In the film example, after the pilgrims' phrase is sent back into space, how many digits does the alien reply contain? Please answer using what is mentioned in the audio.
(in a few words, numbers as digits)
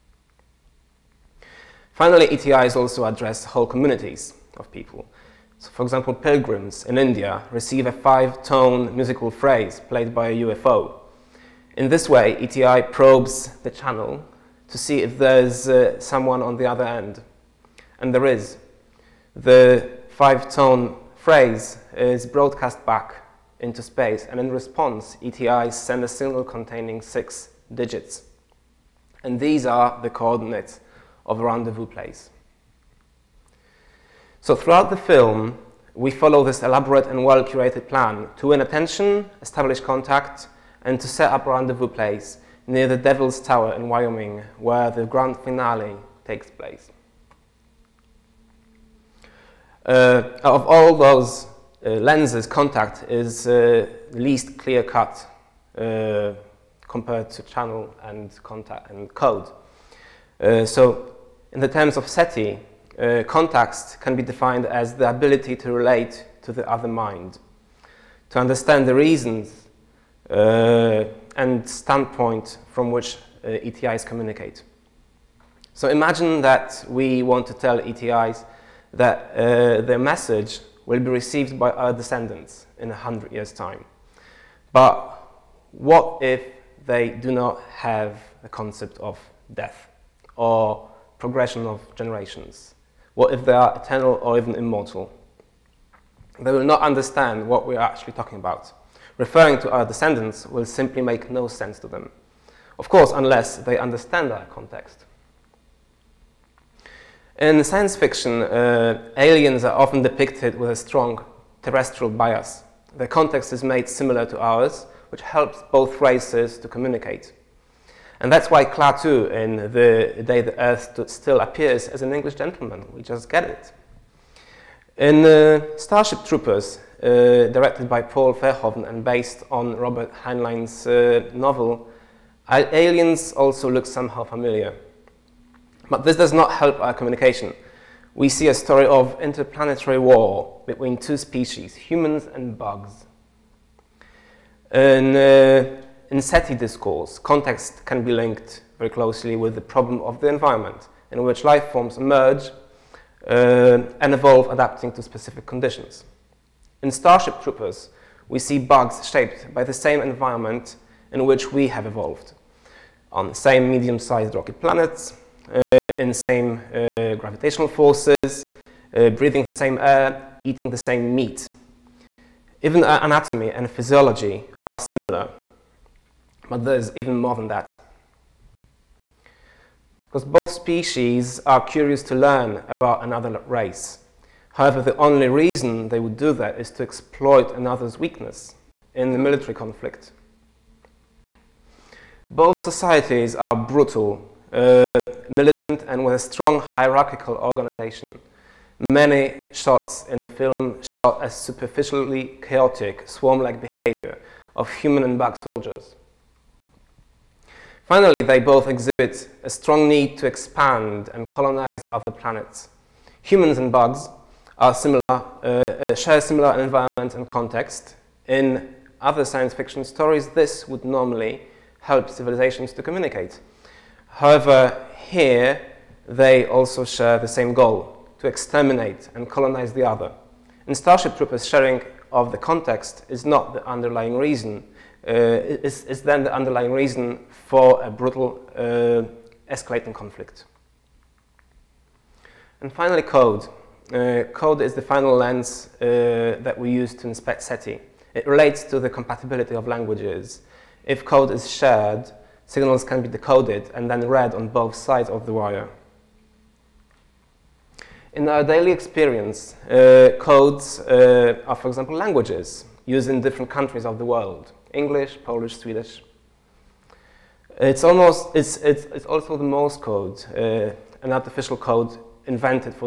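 6.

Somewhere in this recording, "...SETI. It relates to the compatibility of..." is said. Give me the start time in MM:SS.
04:07.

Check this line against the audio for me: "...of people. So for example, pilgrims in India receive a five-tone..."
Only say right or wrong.
right.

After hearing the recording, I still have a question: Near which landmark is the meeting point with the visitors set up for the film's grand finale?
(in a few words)
Devil's Tower.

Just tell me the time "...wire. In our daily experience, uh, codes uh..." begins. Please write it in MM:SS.
04:15.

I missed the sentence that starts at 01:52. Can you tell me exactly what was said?
Their context is made similar to ours, which helps both races to communicate.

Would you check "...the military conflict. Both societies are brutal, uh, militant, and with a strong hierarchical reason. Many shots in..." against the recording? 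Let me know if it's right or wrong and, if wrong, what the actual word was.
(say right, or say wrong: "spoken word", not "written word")
wrong: "organization", not "reason".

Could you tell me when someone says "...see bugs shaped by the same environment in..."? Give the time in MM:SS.
02:38.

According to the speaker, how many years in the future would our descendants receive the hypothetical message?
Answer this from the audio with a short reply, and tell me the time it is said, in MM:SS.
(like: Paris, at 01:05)
100, at 01:22.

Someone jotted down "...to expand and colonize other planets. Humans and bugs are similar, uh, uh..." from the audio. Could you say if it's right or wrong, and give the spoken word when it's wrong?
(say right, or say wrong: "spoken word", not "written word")
right.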